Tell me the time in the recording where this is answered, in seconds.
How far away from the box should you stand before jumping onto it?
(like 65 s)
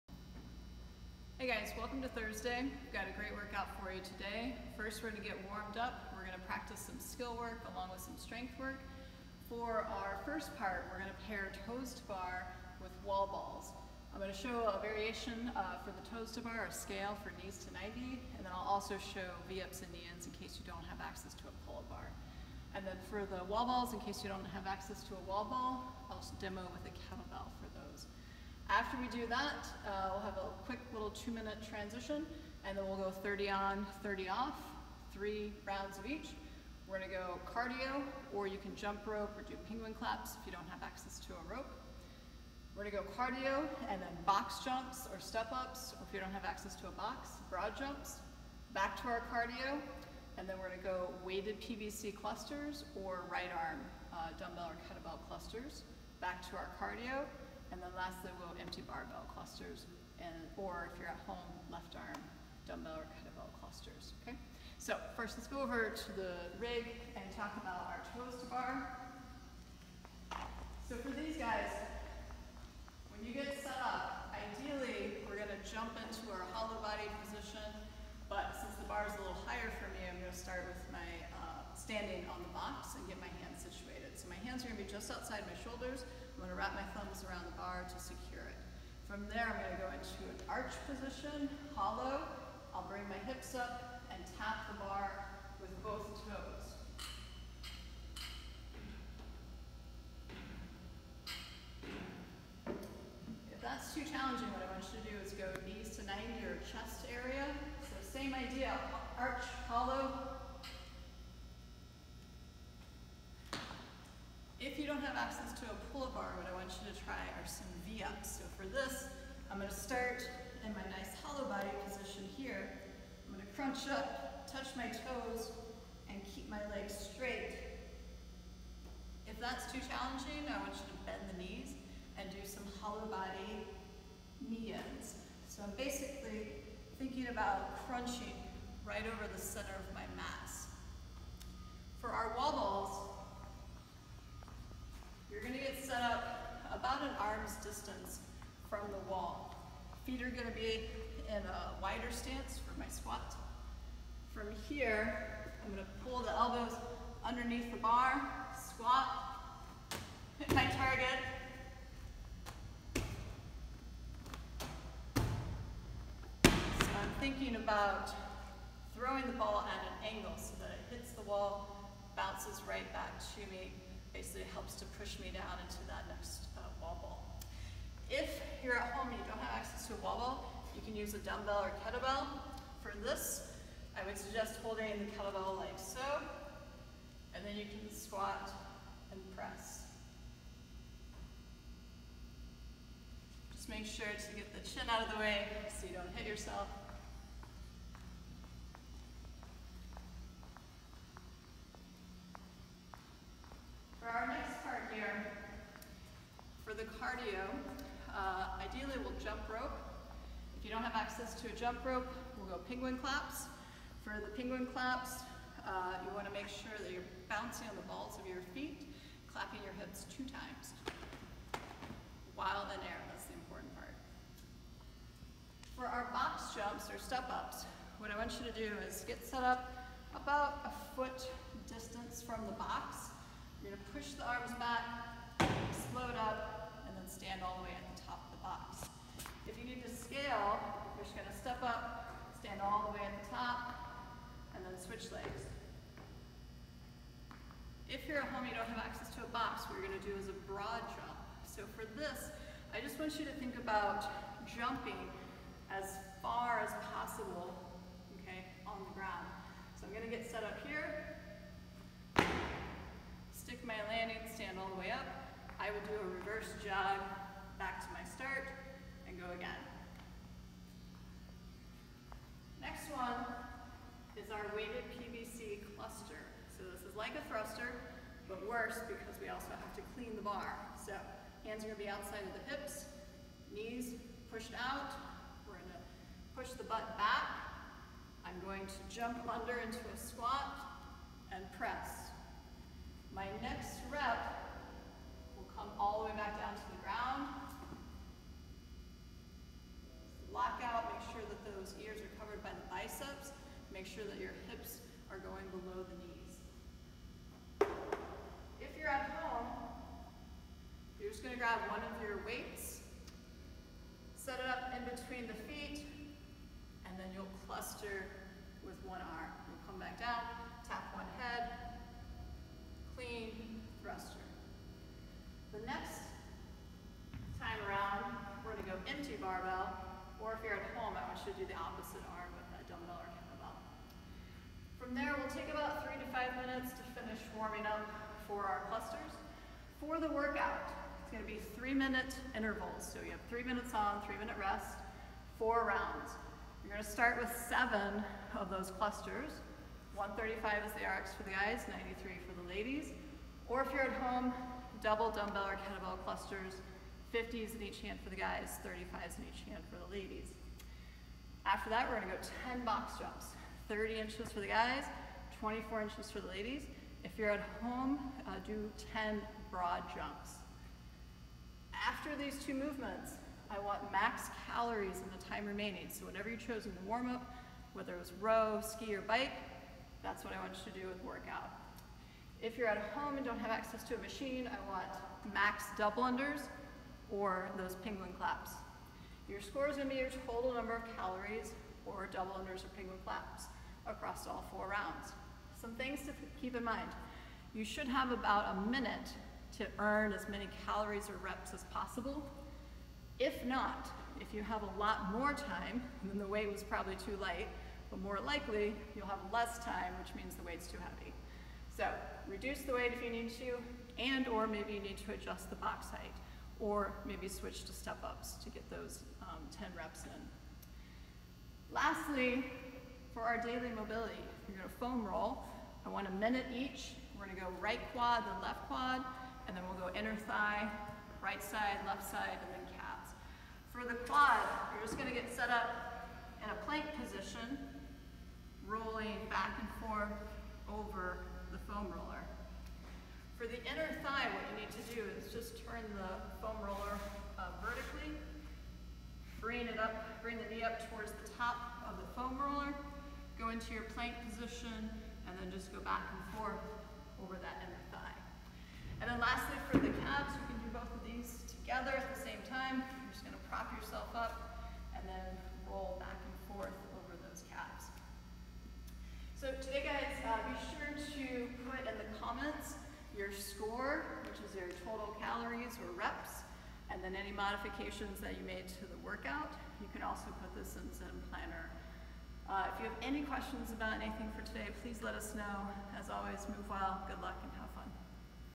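230 s.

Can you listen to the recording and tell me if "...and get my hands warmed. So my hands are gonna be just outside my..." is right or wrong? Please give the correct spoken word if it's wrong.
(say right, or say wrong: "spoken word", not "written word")
wrong: "situated", not "warmed".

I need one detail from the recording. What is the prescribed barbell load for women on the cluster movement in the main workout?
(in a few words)
93.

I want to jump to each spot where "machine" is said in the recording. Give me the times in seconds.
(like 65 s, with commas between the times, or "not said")
383 s.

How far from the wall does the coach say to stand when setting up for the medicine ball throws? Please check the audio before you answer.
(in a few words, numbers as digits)
An arm's distance.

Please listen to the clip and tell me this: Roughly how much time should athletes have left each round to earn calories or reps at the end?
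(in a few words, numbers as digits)
About a minute.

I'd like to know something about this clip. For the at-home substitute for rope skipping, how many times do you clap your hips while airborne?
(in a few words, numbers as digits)
2.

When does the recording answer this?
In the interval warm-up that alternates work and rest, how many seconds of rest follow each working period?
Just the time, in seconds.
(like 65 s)
34 s.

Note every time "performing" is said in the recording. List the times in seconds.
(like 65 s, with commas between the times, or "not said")
not said.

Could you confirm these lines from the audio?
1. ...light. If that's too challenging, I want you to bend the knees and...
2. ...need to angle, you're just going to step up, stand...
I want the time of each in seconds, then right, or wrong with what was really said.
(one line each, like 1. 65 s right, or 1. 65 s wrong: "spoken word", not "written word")
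1. 127 s wrong: "straight", not "light"
2. 239 s wrong: "scale", not "angle".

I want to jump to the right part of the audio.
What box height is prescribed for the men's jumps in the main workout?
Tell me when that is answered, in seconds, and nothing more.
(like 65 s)
363 s.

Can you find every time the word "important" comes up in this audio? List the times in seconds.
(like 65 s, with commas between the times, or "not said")
223 s.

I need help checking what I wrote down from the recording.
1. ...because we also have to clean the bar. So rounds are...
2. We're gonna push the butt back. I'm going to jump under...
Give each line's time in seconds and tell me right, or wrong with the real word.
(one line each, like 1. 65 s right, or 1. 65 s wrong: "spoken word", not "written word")
1. 278 s wrong: "hands", not "rounds"
2. 285 s right.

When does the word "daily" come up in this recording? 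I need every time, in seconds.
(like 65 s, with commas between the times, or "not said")
423 s.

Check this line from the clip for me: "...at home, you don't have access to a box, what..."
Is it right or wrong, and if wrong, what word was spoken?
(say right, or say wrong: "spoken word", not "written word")
right.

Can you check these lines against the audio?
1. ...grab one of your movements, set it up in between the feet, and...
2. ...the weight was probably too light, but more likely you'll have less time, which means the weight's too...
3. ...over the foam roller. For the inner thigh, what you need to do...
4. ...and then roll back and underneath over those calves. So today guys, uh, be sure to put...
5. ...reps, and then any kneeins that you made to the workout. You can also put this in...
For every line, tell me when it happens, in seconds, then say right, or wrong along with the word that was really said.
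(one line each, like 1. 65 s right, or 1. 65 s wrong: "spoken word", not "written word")
1. 311 s wrong: "weights", not "movements"
2. 406 s right
3. 440 s right
4. 464 s wrong: "forth", not "underneath"
5. 475 s wrong: "modifications", not "kneeins".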